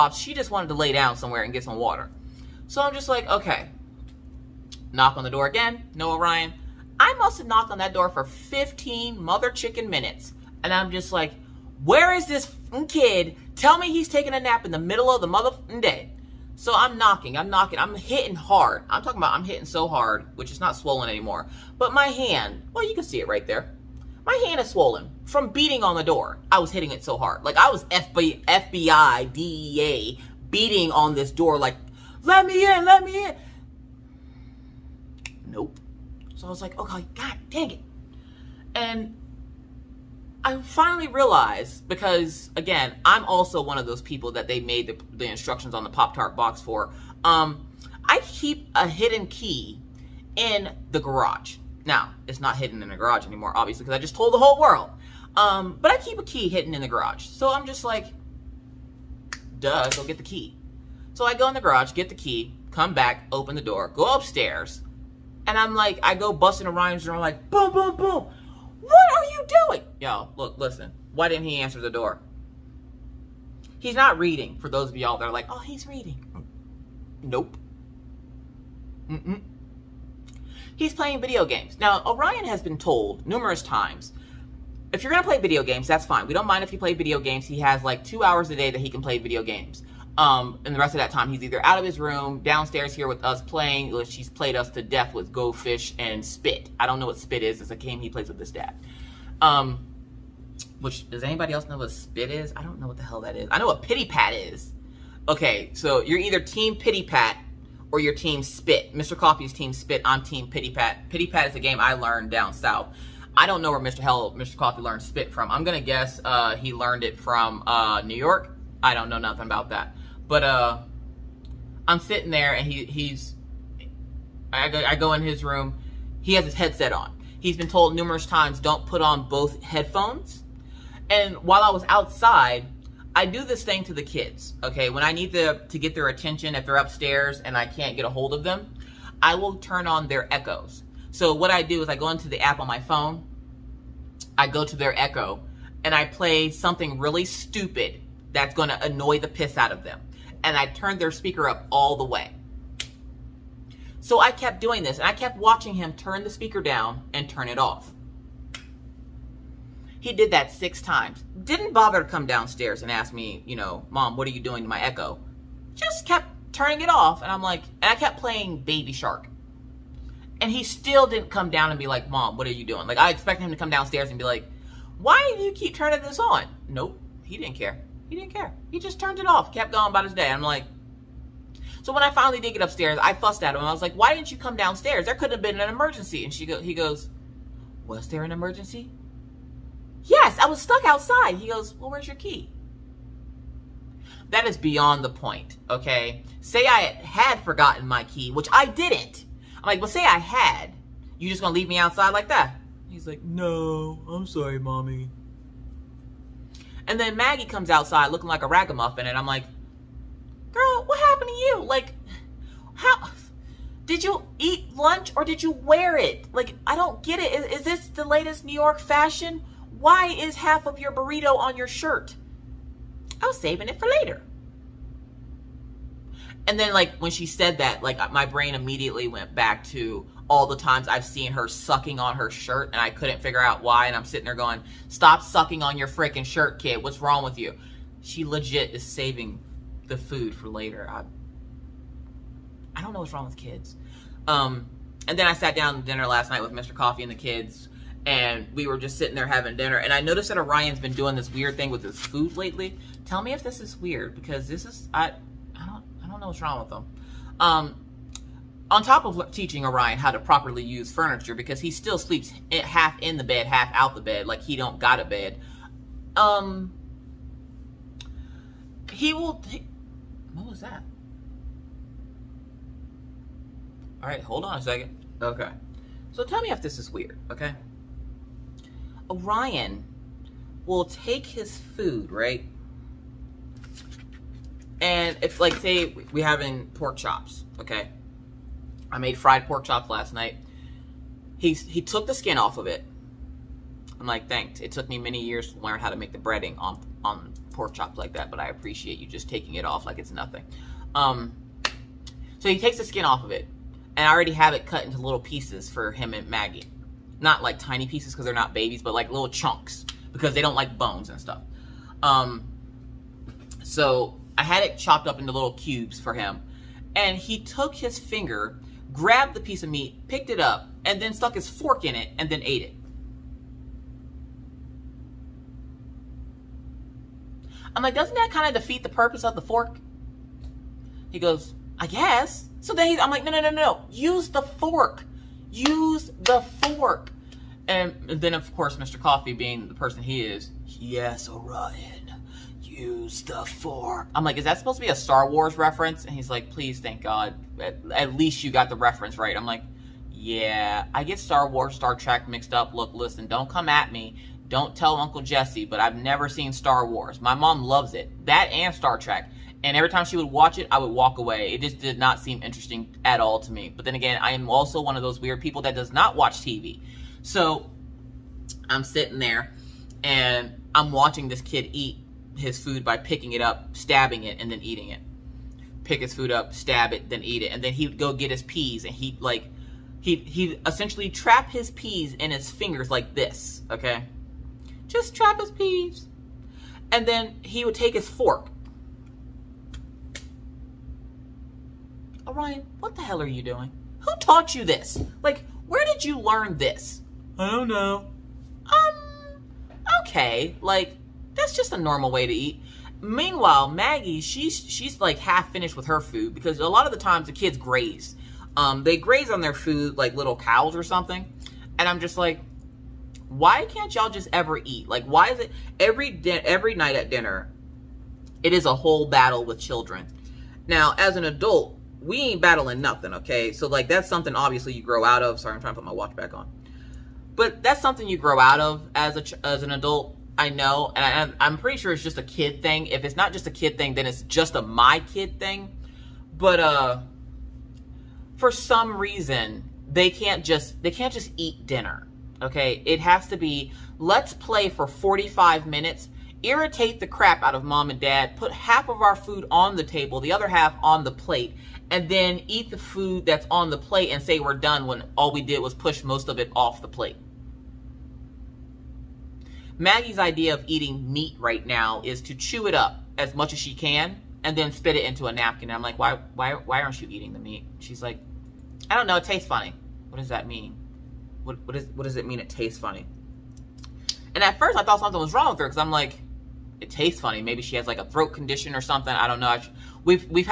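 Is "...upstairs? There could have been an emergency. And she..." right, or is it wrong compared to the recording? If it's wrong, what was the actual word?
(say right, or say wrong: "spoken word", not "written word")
wrong: "downstairs", not "upstairs".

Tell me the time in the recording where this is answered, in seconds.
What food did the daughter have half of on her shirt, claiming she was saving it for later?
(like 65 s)
220 s.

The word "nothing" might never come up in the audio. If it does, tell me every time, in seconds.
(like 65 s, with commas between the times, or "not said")
119 s, 300 s, 422 s.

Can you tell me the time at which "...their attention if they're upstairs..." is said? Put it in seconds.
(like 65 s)
135 s.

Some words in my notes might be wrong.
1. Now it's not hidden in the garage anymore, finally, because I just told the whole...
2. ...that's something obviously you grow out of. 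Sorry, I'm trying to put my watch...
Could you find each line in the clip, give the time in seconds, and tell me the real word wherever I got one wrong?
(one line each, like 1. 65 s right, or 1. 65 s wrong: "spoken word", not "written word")
1. 51 s wrong: "obviously", not "finally"
2. 423 s right.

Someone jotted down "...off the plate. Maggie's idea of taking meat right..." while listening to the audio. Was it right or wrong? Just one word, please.
wrong.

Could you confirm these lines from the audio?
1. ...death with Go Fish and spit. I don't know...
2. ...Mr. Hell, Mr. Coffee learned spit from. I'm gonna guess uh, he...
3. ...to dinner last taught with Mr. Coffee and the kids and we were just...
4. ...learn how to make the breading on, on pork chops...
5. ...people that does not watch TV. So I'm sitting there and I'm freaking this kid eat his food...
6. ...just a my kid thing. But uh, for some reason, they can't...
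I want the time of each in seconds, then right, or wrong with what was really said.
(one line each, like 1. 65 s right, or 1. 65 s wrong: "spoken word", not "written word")
1. 94 s right
2. 113 s right
3. 245 s wrong: "night", not "taught"
4. 295 s right
5. 365 s wrong: "watching", not "freaking"
6. 434 s right.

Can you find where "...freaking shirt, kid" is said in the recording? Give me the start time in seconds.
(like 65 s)
235 s.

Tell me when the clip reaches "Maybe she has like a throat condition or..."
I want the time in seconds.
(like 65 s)
477 s.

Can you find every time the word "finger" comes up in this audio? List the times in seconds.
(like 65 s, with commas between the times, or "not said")
317 s, 382 s.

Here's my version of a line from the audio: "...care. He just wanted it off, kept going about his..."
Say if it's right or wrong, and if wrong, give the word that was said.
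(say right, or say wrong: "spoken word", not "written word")
wrong: "turned", not "wanted".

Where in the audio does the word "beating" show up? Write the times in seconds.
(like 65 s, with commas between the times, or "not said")
25 s, 30 s.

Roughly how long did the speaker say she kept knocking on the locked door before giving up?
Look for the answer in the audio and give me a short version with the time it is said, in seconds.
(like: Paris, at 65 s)
15 minutes, at 8 s.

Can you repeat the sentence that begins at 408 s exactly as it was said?
Um, they graze on their food like little cows or something.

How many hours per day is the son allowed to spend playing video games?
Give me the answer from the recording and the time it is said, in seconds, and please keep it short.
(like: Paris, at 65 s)
2 hours, at 88 s.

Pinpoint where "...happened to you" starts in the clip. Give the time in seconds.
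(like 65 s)
210 s.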